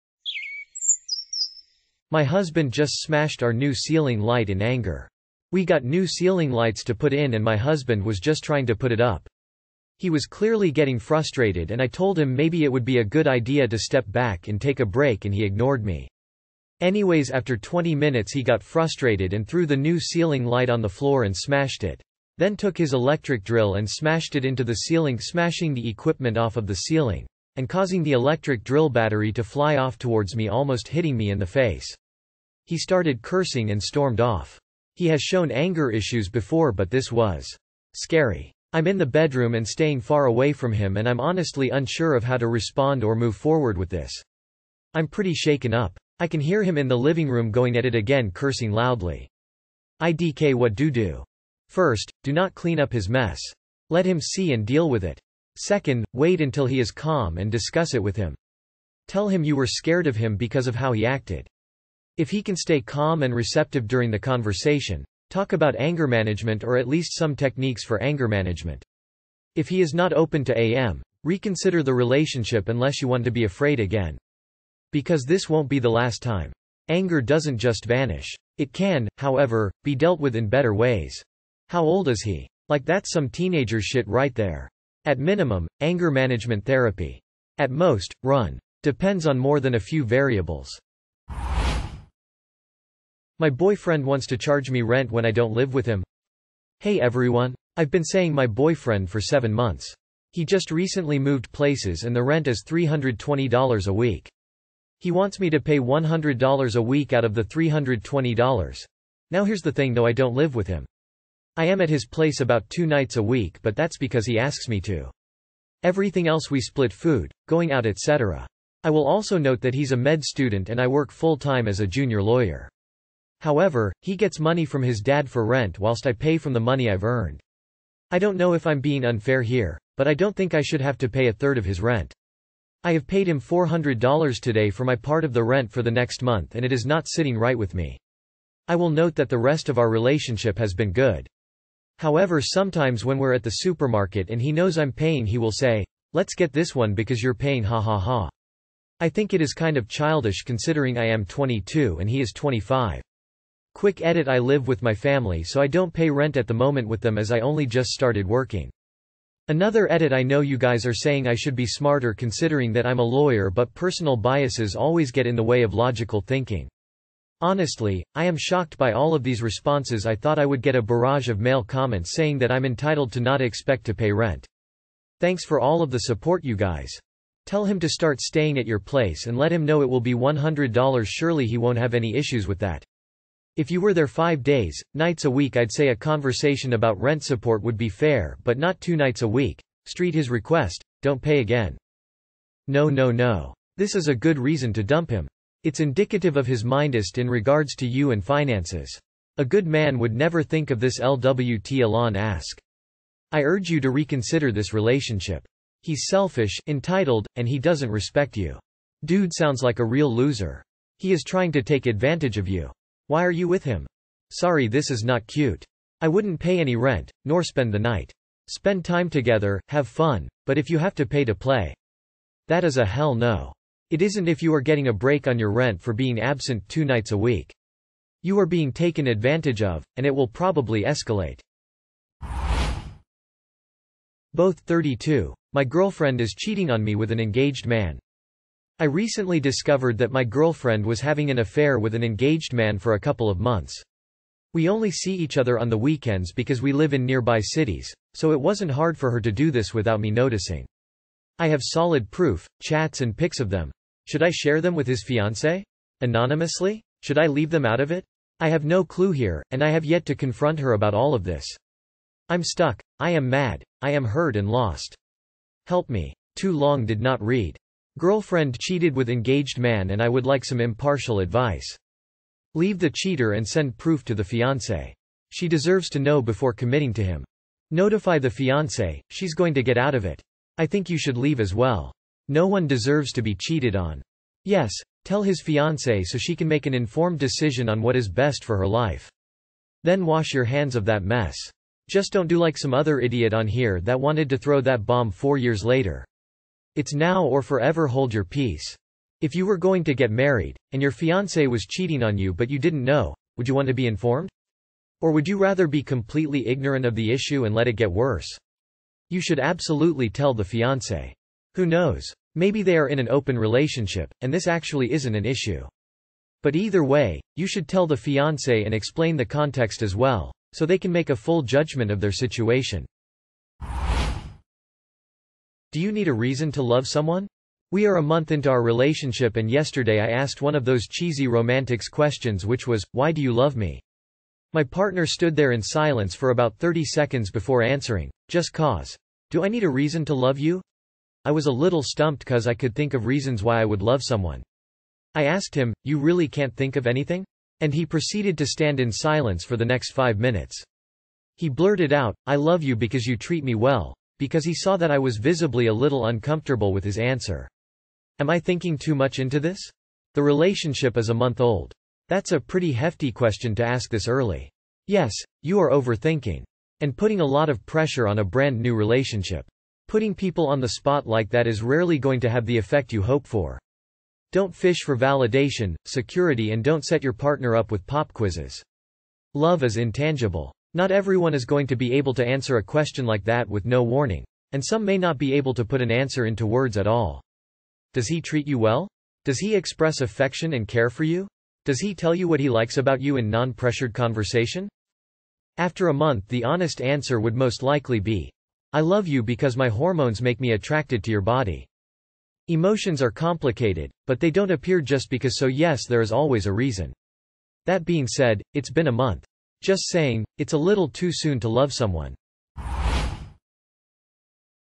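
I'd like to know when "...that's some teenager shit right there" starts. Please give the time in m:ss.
1:22.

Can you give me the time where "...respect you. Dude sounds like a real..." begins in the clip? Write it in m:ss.
3:27.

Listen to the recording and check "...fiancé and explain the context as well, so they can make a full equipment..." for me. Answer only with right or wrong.
wrong.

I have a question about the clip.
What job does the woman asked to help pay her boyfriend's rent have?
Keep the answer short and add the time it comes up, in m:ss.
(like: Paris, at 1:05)
junior lawyer, at 2:01.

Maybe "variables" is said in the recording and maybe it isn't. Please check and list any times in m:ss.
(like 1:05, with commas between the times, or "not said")
1:30.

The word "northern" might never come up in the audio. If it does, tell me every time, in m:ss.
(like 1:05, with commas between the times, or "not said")
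not said.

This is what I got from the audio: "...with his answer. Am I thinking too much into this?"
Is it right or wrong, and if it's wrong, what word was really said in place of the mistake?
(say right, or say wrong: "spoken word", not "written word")
right.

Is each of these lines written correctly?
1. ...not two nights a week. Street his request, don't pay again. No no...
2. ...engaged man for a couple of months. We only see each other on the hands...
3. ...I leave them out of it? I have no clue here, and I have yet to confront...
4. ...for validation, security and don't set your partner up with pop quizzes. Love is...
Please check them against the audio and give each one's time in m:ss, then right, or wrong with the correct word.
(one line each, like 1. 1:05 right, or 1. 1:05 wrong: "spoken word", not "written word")
1. 3:08 right
2. 4:02 wrong: "weekends", not "hands"
3. 4:17 right
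4. 6:14 right.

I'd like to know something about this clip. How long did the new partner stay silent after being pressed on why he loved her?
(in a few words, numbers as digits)
5 minutes.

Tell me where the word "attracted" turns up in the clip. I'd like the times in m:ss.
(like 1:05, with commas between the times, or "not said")
6:40.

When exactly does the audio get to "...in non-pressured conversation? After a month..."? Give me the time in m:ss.
6:33.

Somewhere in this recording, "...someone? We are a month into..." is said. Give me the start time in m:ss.
5:26.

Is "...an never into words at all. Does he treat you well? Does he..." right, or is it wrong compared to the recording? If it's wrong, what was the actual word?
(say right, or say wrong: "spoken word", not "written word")
wrong: "answer", not "never".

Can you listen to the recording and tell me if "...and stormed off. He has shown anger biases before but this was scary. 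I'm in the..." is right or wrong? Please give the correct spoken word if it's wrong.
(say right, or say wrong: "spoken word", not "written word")
wrong: "issues", not "biases".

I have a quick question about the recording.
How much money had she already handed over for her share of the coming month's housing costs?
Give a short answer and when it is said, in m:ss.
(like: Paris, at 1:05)
$400, at 2:13.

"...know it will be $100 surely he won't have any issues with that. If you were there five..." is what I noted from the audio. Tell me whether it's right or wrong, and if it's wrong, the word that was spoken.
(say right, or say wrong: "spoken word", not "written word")
right.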